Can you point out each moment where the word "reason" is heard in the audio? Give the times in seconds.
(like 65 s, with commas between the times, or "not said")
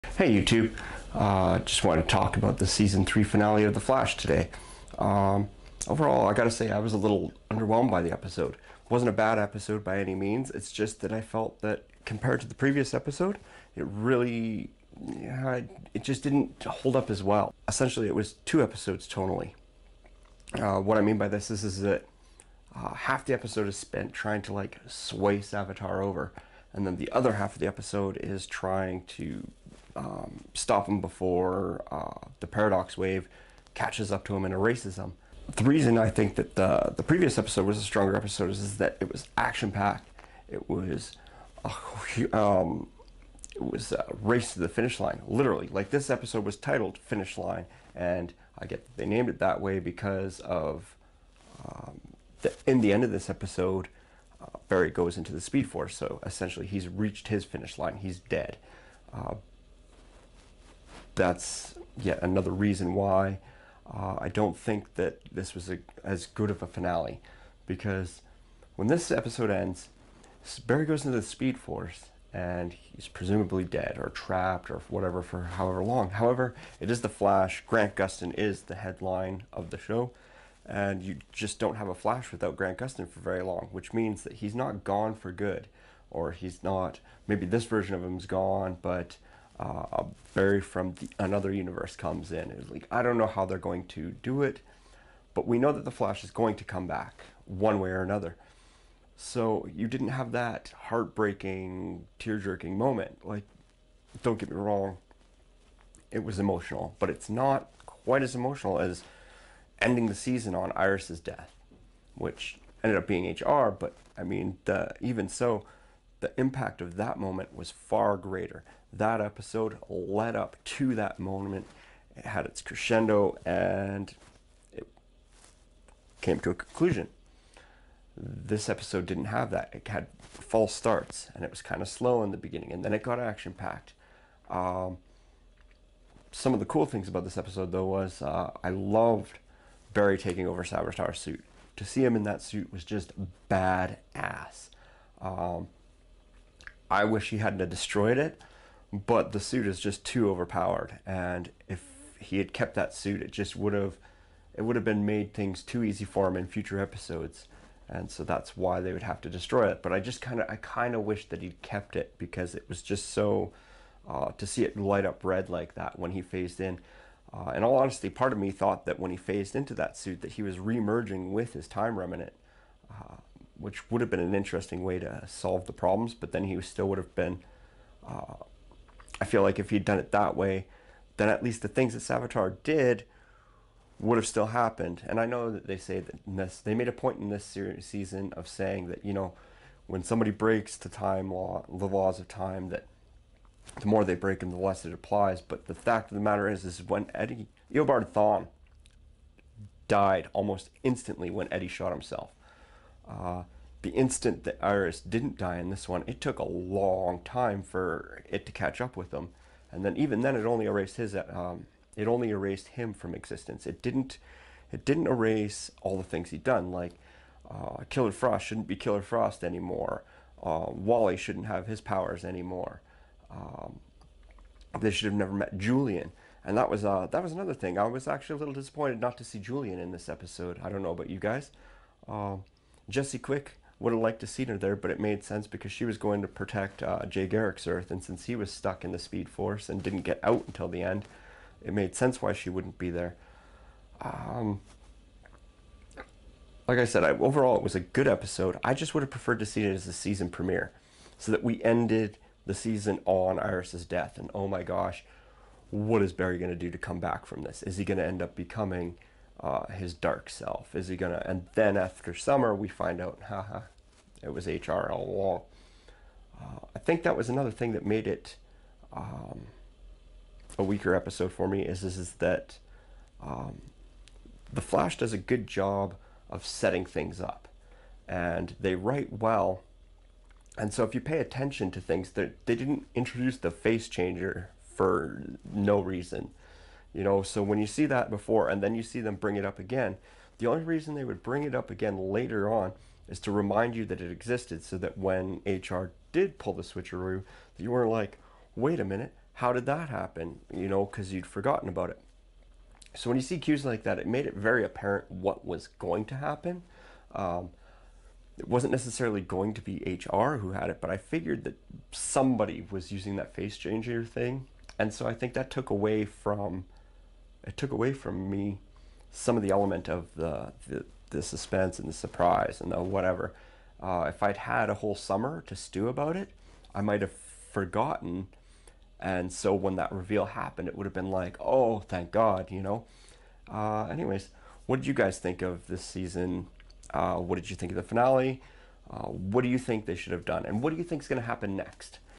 35 s, 62 s, 285 s, 290 s.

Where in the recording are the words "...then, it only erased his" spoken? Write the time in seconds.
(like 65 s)
210 s.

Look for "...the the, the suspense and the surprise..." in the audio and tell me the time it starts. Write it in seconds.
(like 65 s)
320 s.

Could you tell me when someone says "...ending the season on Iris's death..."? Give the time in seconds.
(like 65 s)
109 s.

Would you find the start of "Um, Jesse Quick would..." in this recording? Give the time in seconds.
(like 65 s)
232 s.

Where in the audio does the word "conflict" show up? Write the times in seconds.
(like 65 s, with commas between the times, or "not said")
not said.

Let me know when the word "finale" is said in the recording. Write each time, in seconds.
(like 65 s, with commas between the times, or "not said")
3 s, 66 s, 337 s.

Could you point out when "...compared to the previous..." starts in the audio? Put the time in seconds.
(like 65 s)
12 s.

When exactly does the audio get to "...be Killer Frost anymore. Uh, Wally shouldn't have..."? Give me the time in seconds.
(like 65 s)
218 s.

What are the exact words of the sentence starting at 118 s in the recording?
That episode led up to that moment, it had its crescendo, and it came to a conclusion.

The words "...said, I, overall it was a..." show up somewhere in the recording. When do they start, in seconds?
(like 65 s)
246 s.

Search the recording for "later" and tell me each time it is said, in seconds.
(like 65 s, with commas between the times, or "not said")
292 s.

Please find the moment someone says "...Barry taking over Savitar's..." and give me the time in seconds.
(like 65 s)
139 s.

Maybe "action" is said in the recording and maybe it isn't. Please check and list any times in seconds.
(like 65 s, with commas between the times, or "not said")
39 s, 133 s.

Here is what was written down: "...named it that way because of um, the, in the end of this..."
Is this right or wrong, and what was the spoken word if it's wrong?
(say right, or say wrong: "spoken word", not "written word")
right.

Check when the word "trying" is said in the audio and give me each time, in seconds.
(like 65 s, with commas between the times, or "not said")
24 s, 28 s.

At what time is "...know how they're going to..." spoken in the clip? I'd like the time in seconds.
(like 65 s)
93 s.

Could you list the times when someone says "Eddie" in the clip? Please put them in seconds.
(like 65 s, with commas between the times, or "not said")
197 s, 201 s.